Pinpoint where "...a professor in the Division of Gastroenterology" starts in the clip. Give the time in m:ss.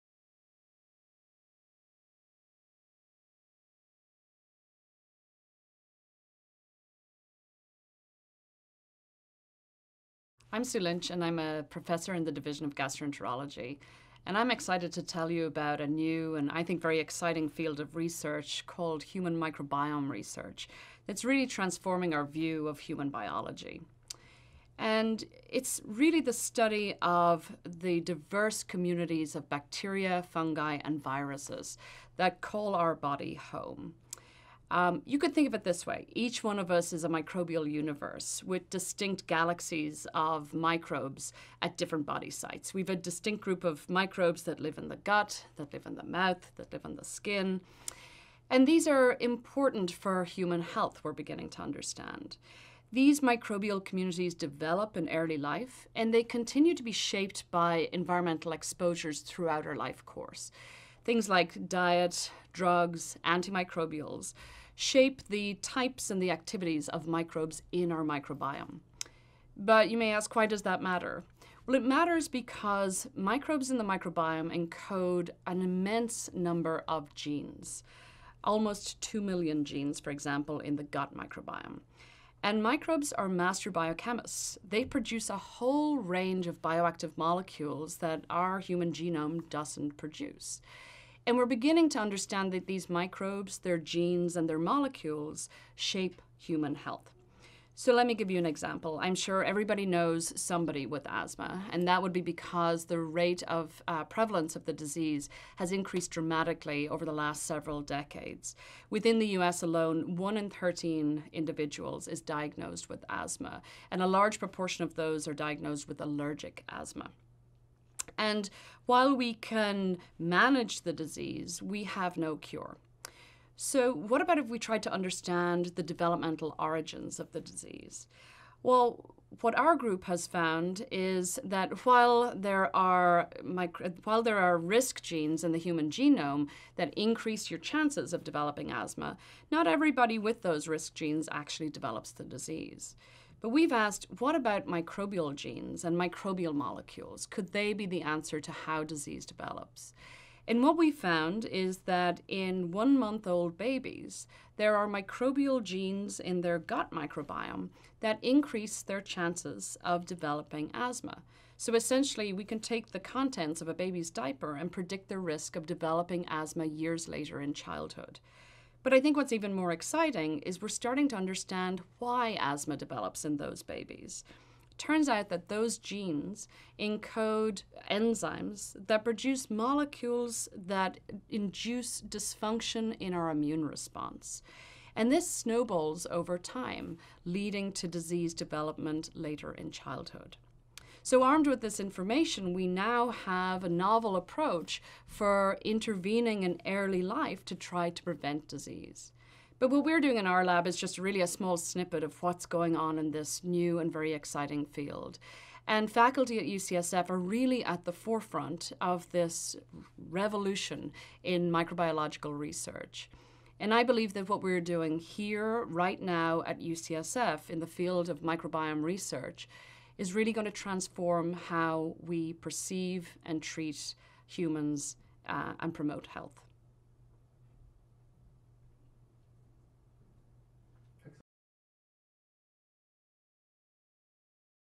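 0:11.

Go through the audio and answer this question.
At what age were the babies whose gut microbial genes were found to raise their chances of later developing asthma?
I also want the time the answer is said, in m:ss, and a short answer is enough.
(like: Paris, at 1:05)
1 month, at 2:32.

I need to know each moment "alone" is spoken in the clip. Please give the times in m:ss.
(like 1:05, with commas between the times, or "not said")
1:49.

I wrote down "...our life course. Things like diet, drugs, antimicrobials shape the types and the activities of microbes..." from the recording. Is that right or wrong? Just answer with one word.
right.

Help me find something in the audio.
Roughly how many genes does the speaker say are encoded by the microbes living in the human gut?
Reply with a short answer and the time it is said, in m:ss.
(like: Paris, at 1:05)
2 million, at 1:18.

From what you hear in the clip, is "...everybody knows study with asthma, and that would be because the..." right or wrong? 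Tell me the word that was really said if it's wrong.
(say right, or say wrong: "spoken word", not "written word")
wrong: "somebody", not "study".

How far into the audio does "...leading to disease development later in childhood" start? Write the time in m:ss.
3:07.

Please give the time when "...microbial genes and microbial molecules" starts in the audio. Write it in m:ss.
2:24.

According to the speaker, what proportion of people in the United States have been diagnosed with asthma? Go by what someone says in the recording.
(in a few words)
1 in 13.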